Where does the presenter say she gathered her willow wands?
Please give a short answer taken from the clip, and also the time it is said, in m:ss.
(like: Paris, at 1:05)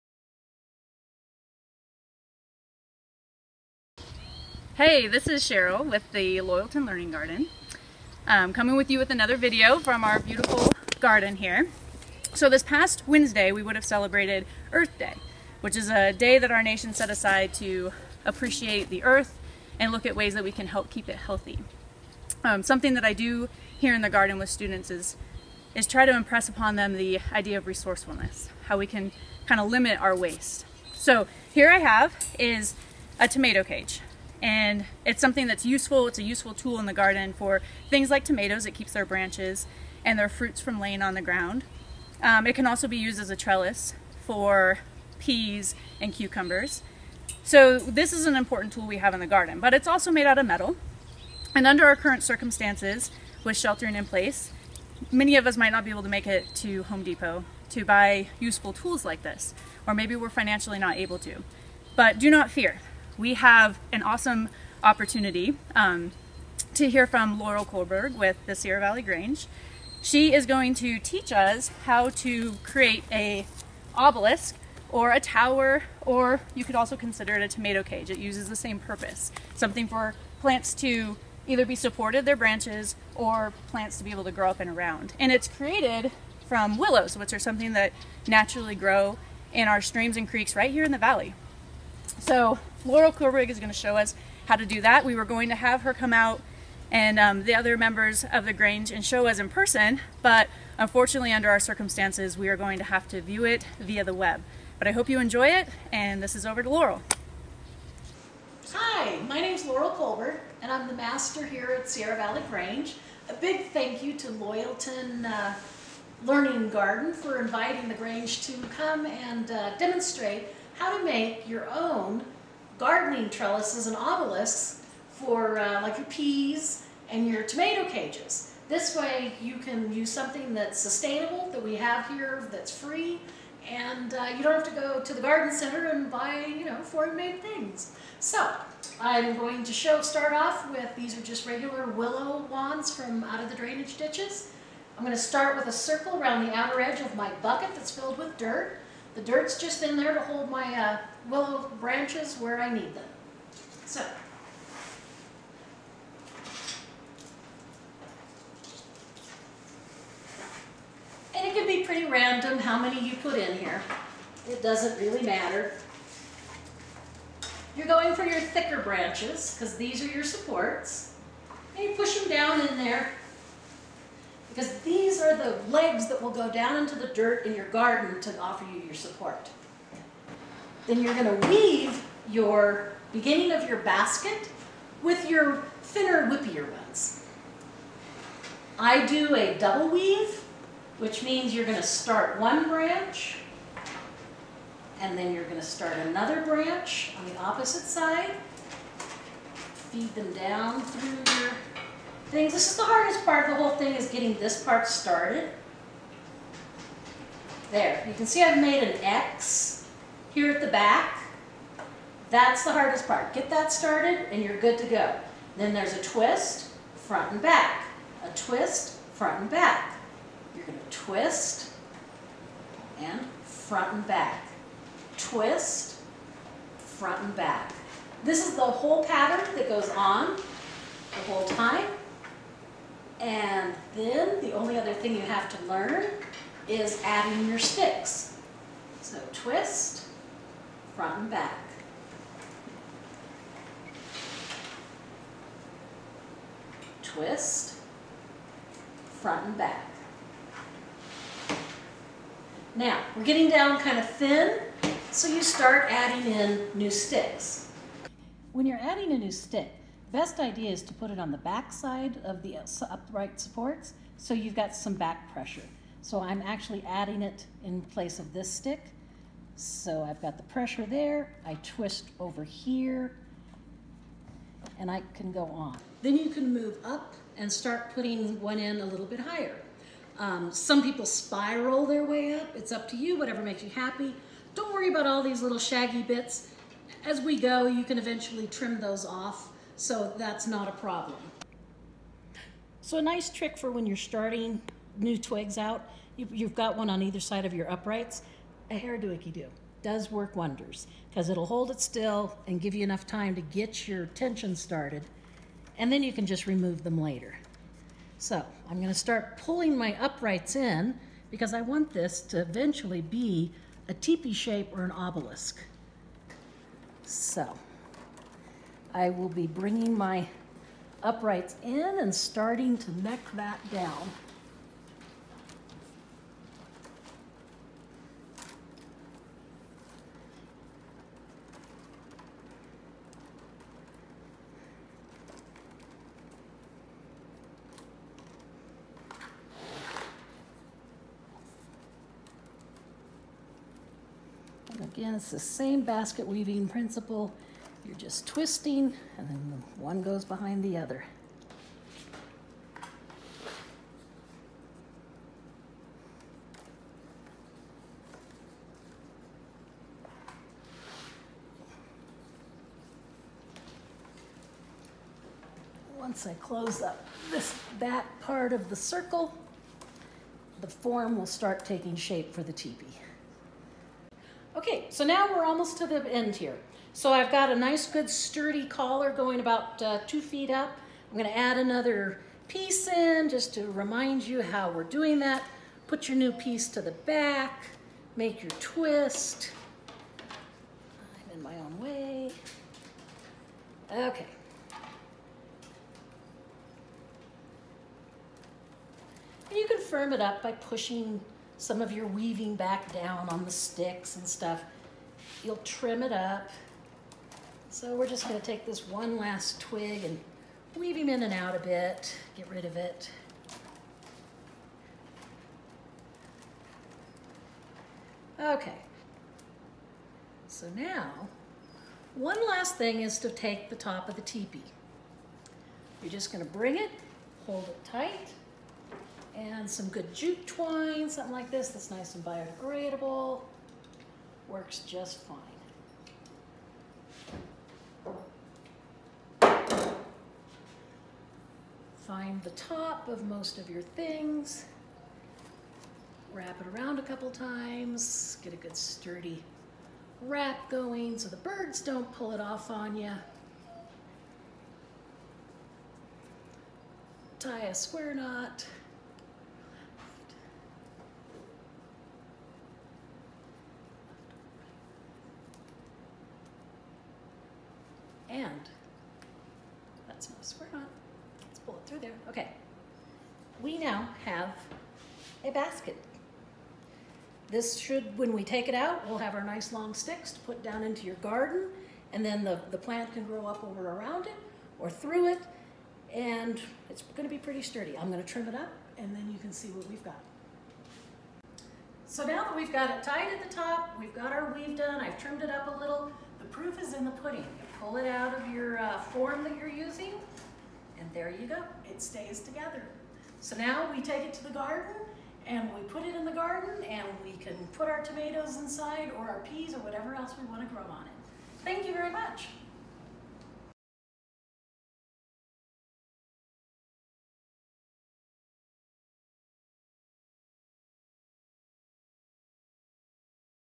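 drainage ditches, at 2:23.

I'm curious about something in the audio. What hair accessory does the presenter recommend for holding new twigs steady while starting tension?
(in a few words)
hair icky do.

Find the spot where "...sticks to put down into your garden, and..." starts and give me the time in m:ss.
7:59.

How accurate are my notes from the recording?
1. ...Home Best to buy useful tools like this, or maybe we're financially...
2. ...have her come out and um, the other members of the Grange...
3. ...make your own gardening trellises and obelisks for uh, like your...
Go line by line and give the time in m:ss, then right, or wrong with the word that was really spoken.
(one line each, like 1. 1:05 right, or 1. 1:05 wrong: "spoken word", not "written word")
1. 0:56 wrong: "Depot", not "Best"
2. 1:35 right
3. 2:01 right.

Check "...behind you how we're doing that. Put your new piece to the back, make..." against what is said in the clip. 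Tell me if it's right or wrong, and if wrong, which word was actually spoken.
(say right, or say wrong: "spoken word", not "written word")
wrong: "remind", not "behind".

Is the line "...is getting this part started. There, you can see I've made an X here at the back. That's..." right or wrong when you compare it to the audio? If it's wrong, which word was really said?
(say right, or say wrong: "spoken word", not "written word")
right.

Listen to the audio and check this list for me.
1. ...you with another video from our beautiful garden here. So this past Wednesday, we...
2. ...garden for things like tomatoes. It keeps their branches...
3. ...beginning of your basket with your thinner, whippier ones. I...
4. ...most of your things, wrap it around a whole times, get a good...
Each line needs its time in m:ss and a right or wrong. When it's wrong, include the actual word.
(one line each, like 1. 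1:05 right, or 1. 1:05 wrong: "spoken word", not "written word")
1. 0:08 right
2. 0:36 right
3. 3:03 right
4. 7:23 wrong: "couple", not "whole".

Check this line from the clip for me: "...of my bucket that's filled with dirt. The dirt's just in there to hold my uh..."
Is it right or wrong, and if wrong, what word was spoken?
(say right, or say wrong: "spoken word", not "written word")
right.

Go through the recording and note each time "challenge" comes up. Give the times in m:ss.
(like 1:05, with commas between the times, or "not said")
not said.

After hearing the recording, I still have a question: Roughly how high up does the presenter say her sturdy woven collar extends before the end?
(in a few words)
2 feet.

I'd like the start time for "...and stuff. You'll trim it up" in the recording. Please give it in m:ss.
6:44.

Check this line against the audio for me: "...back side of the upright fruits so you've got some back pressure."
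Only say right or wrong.
wrong.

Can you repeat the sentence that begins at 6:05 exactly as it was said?
once I close up this that part of the circle, the form will start taking shape for the teepee.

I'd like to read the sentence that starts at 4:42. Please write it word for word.
It's up to you, whatever makes you happy.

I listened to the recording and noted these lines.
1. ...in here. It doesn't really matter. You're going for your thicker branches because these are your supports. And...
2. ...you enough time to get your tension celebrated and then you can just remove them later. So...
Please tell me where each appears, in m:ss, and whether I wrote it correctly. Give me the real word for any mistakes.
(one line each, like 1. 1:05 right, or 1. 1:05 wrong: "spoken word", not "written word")
1. 2:43 right
2. 5:02 wrong: "started", not "celebrated".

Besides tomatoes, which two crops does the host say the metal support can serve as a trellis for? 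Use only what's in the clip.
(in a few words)
peas and cucumbers.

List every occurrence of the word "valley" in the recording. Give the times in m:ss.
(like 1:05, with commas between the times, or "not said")
1:08, 1:30, 1:52.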